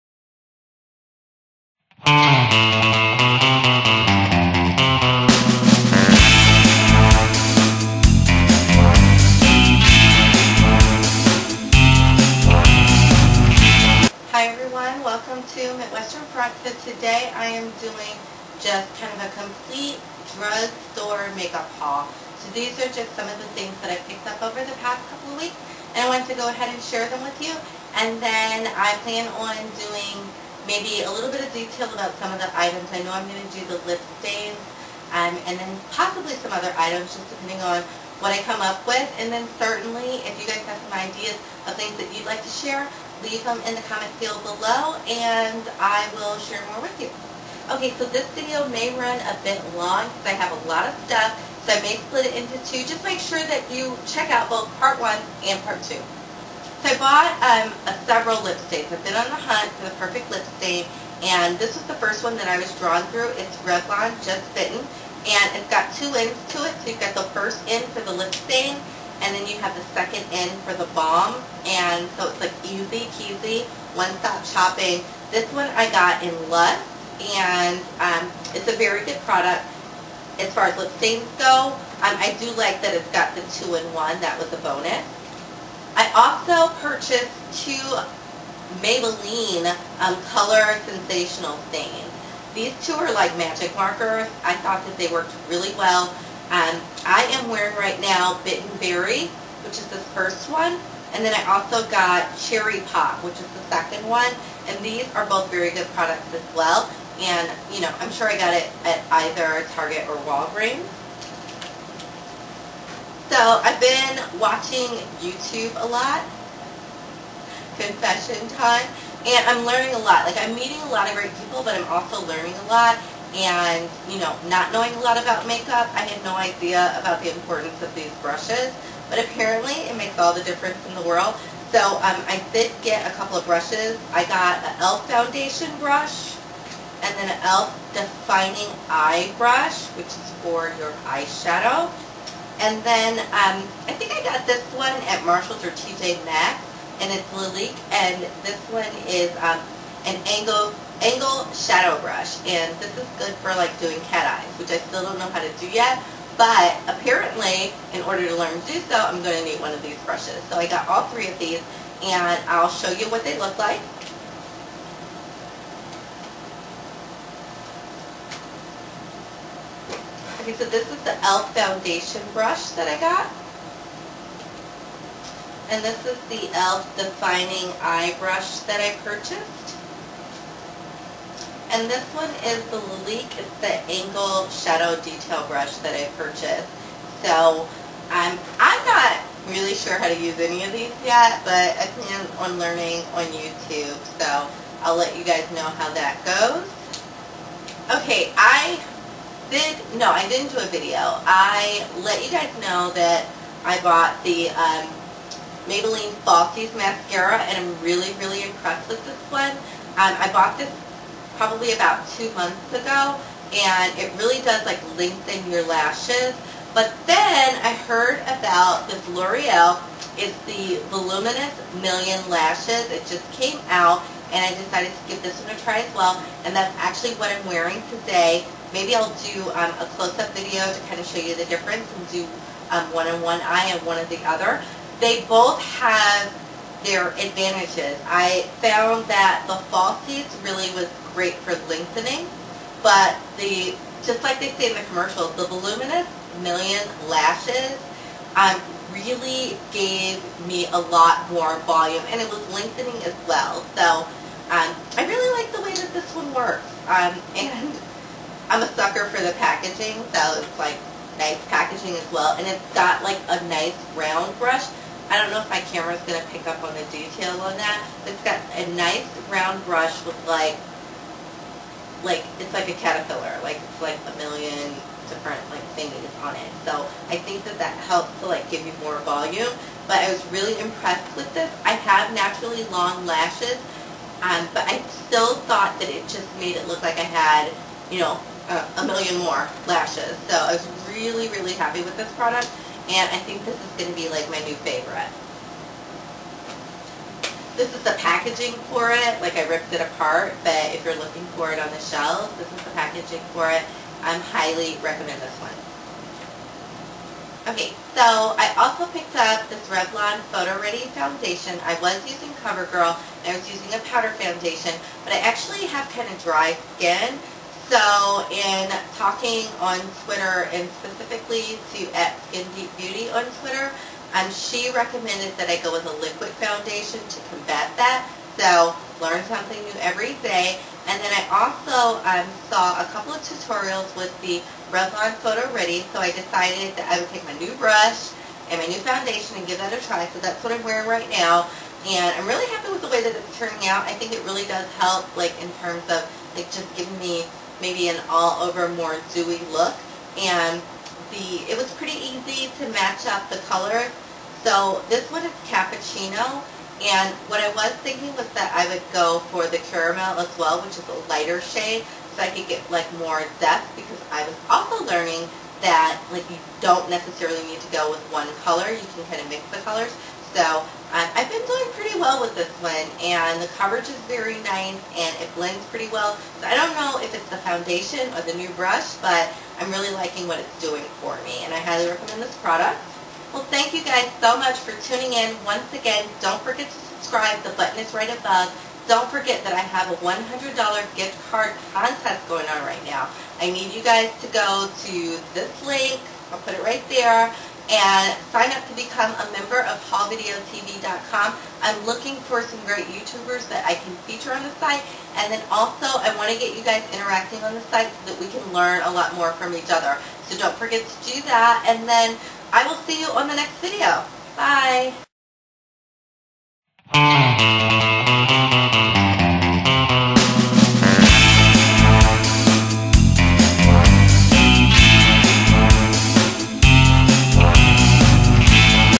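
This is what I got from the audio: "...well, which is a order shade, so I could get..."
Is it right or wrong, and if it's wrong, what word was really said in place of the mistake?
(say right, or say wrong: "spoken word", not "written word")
wrong: "lighter", not "order".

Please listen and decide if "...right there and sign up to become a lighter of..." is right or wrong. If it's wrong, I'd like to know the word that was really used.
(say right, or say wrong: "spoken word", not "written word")
wrong: "member", not "lighter".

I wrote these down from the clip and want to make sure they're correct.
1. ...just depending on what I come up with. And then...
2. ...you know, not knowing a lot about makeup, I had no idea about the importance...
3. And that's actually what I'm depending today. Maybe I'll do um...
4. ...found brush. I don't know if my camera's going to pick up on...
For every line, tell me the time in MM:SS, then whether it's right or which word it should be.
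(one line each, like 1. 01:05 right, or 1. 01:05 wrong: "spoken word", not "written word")
1. 00:37 right
2. 02:04 right
3. 03:46 wrong: "wearing", not "depending"
4. 04:23 wrong: "round", not "found".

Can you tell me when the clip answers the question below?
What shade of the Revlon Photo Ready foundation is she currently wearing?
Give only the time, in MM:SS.
05:55.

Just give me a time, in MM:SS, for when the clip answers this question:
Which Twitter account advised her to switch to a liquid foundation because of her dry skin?
05:22.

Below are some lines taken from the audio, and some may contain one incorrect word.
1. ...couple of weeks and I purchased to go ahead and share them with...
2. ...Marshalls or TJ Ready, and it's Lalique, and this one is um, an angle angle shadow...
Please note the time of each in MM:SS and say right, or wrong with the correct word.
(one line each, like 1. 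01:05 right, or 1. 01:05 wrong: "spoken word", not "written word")
1. 00:25 wrong: "wanted", not "purchased"
2. 02:25 wrong: "Maxx", not "Ready".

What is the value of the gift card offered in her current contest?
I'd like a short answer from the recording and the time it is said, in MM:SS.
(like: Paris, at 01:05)
$100, at 06:30.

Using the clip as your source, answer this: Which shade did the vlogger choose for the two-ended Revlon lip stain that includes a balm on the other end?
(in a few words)
Lust.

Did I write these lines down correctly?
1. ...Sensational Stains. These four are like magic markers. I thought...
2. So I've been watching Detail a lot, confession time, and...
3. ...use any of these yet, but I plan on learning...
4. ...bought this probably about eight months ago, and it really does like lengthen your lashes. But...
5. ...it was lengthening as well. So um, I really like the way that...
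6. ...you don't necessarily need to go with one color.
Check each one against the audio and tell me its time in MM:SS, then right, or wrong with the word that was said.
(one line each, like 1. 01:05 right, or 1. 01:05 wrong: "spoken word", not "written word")
1. 01:30 wrong: "two", not "four"
2. 01:53 wrong: "YouTube", not "Detail"
3. 03:10 right
4. 03:30 wrong: "two", not "eight"
5. 04:12 right
6. 06:06 right.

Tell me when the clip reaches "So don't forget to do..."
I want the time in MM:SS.
06:50.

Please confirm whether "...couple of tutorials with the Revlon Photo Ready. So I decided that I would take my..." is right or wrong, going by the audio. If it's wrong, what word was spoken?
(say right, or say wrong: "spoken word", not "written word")
right.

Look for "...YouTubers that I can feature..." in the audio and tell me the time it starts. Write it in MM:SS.
06:42.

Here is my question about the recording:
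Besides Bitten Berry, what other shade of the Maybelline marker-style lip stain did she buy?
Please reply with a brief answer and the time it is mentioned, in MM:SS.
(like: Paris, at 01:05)
Cherry Pop, at 01:42.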